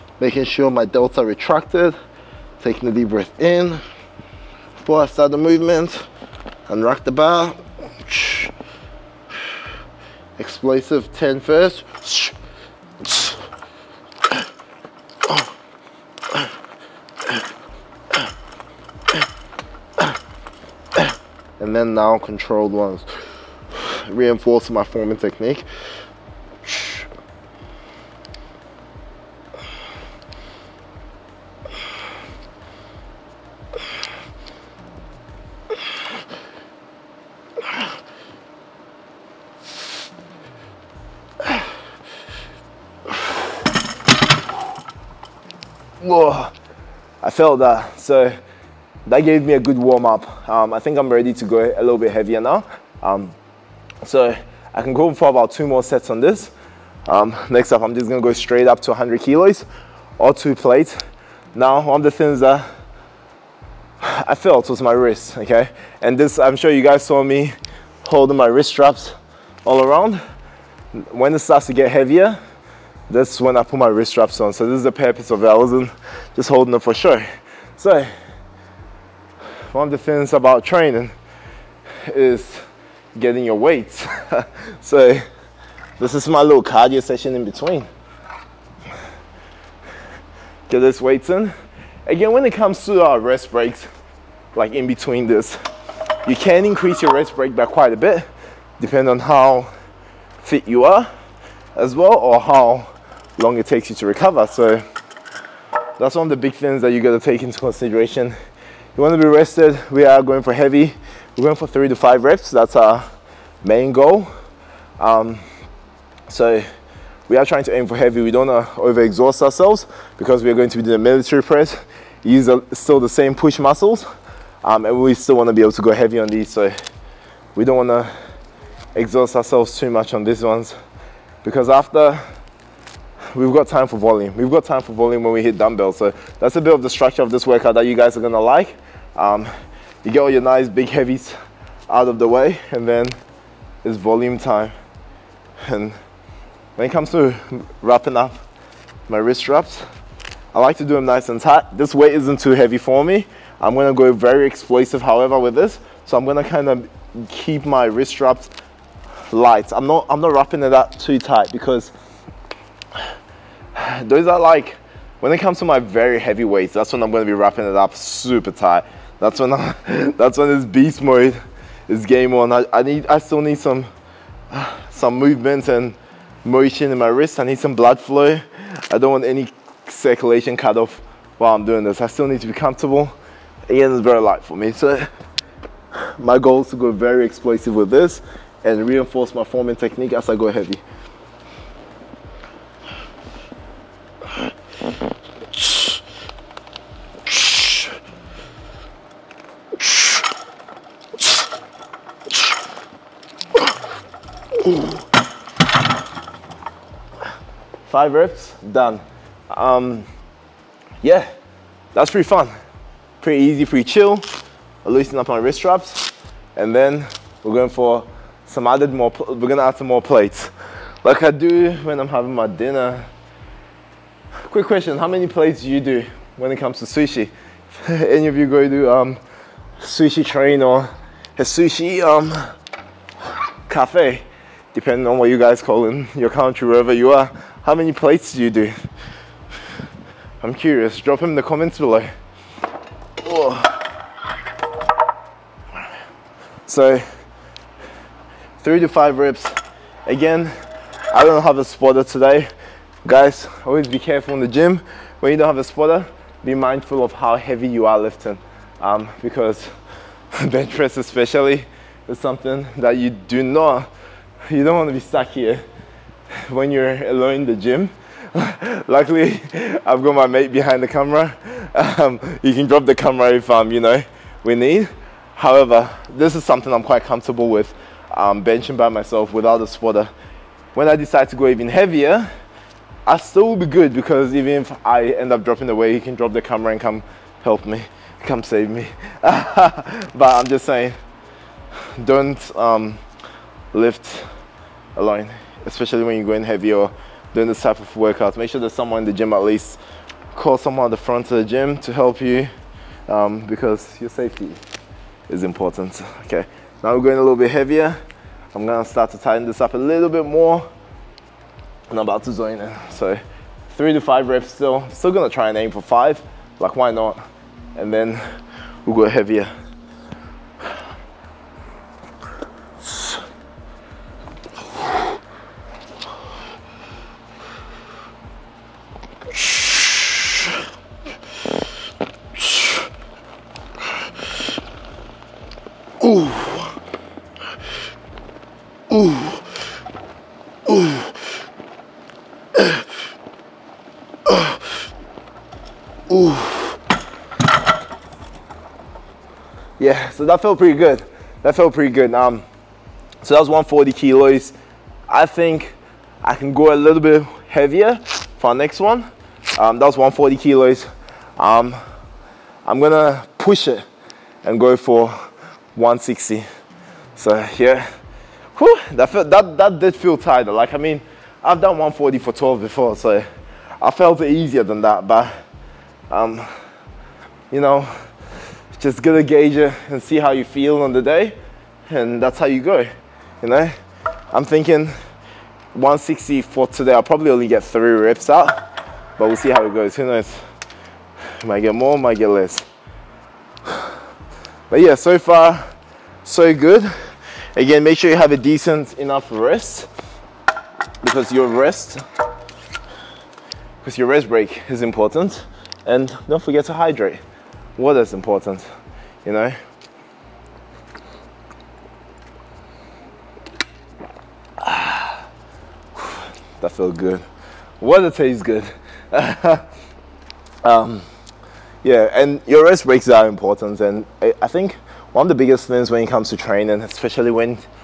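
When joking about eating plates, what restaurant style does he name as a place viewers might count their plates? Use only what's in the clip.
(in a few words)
sushi train.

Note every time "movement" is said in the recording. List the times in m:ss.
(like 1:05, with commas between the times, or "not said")
0:05, 2:55.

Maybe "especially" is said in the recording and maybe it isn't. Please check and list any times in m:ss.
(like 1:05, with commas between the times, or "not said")
4:20, 4:55, 7:06.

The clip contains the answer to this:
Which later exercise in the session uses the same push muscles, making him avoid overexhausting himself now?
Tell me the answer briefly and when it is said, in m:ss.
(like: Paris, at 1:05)
military press, at 2:00.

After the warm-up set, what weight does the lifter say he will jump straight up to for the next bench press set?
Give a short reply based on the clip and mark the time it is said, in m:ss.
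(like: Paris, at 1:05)
100 kilos, at 0:58.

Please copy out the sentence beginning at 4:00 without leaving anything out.
I'm curious, drop them in the comments below.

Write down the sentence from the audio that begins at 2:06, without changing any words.
So we don't want to exhaust ourselves too much on these ones because after we've got time for volume.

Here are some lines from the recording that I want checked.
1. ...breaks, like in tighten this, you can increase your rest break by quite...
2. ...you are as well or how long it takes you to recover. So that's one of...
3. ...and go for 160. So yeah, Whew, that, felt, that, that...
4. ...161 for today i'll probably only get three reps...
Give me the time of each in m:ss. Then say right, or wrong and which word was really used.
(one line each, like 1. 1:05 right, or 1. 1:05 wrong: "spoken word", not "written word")
1. 1:33 wrong: "between", not "tighten"
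2. 1:40 right
3. 6:04 right
4. 6:25 wrong: "160", not "161".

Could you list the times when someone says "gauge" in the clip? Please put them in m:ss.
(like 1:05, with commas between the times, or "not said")
6:19.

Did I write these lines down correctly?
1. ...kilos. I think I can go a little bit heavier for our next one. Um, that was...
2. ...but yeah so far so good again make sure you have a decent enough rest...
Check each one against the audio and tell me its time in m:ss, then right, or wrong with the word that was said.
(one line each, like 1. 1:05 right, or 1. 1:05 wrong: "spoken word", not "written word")
1. 5:53 right
2. 6:34 right.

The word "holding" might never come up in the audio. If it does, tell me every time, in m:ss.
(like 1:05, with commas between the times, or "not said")
1:08, 1:16.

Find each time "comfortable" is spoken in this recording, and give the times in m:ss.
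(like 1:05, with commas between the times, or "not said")
3:02, 4:37.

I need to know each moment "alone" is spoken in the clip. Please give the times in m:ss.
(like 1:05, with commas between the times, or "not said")
4:27, 4:54.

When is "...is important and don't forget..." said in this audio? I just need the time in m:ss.
6:44.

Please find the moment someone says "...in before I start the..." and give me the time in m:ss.
0:03.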